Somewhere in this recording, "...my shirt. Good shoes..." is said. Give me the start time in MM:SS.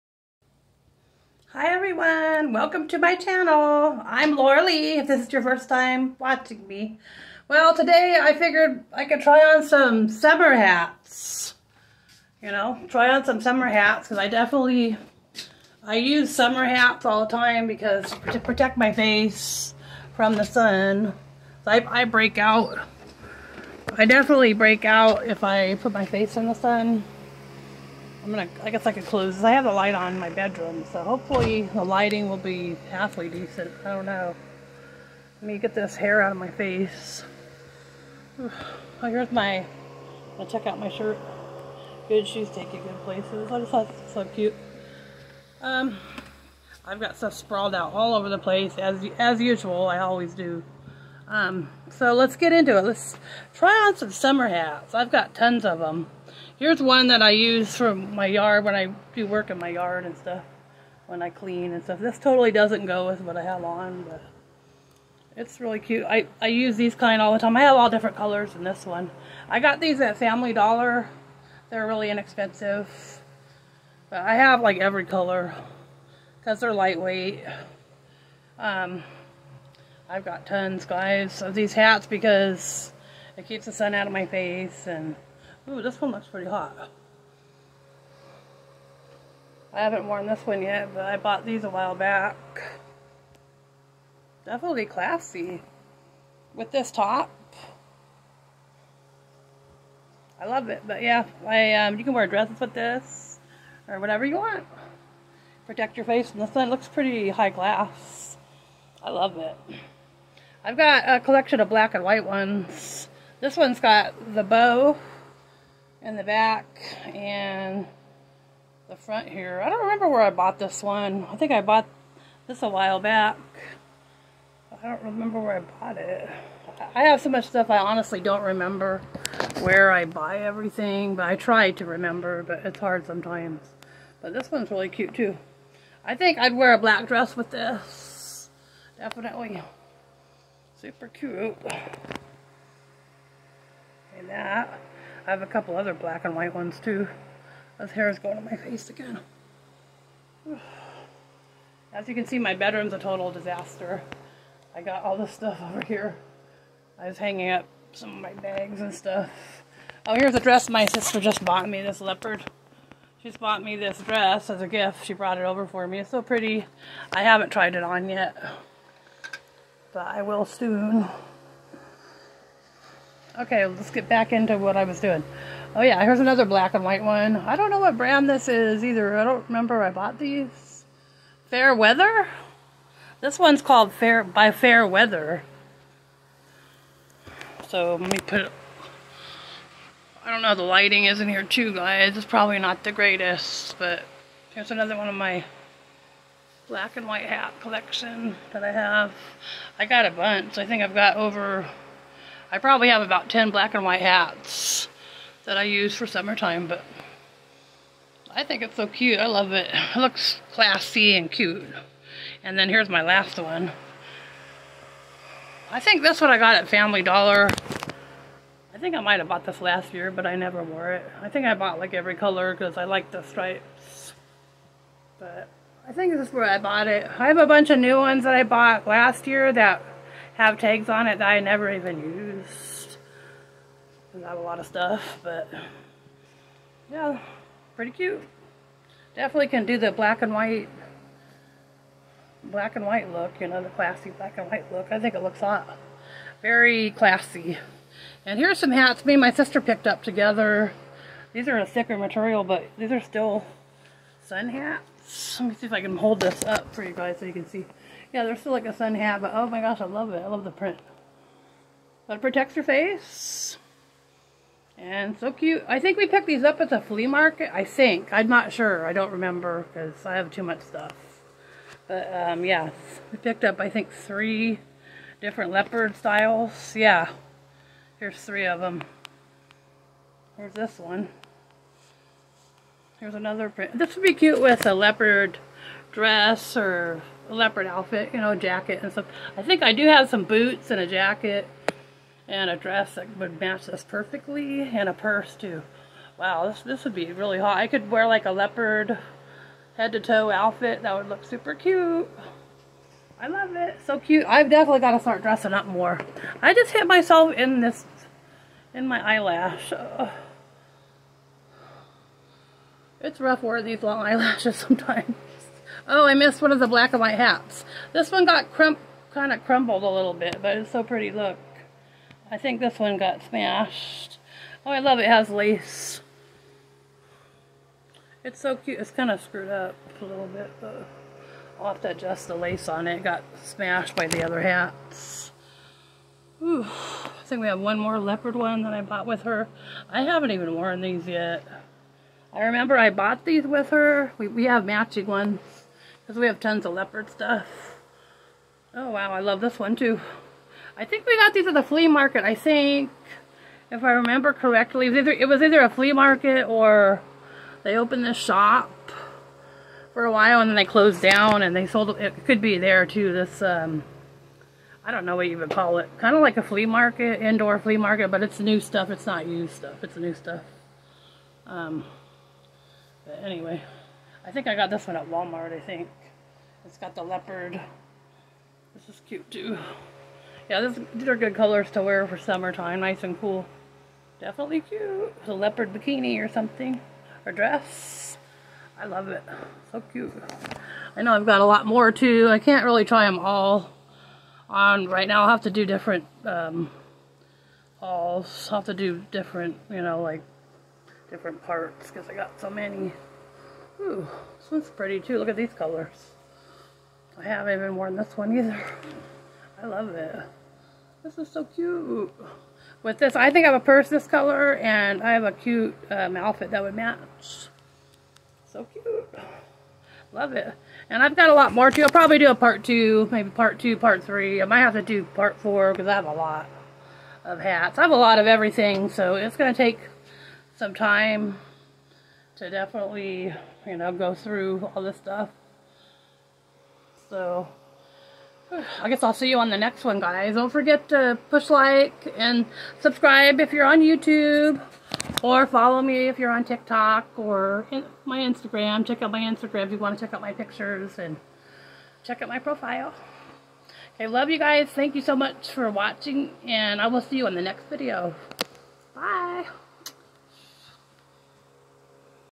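00:40.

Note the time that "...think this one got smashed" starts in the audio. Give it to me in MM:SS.
05:22.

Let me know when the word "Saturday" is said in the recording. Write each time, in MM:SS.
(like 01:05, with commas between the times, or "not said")
not said.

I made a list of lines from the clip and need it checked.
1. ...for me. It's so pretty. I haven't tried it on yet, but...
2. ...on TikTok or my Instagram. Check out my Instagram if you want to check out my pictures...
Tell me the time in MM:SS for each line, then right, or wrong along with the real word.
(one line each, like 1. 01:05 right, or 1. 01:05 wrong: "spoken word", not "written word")
1. 02:45 right
2. 07:26 right.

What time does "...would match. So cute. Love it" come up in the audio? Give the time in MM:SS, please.
06:56.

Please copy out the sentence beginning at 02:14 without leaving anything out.
But this one's really cute too.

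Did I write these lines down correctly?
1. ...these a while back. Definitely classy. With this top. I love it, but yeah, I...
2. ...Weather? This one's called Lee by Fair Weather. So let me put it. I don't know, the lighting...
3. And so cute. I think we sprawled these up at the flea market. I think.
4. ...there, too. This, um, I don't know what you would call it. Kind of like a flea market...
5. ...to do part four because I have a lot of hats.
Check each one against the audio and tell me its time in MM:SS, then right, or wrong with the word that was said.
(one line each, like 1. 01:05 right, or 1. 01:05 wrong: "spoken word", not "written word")
1. 01:31 right
2. 03:01 wrong: "Fair", not "Lee"
3. 04:24 wrong: "picked", not "sprawled"
4. 06:02 right
5. 07:04 right.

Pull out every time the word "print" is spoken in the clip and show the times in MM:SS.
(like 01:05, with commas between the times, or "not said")
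04:20, 04:43.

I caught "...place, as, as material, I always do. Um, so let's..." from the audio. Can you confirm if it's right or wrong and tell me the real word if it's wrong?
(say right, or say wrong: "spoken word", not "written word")
wrong: "usual", not "material".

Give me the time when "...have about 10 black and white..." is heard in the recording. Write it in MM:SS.
03:22.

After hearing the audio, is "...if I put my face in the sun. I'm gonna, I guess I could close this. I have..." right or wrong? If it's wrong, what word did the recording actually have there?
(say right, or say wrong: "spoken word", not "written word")
right.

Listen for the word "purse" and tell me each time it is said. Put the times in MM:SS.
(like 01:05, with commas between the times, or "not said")
04:54, 06:53.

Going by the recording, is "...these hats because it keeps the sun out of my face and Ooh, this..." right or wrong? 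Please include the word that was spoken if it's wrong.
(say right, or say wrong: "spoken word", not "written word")
right.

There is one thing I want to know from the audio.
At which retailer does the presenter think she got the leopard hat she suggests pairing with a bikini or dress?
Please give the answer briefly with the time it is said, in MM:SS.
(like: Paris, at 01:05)
Walmart, at 06:15.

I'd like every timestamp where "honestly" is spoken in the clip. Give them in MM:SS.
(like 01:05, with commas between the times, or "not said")
02:07.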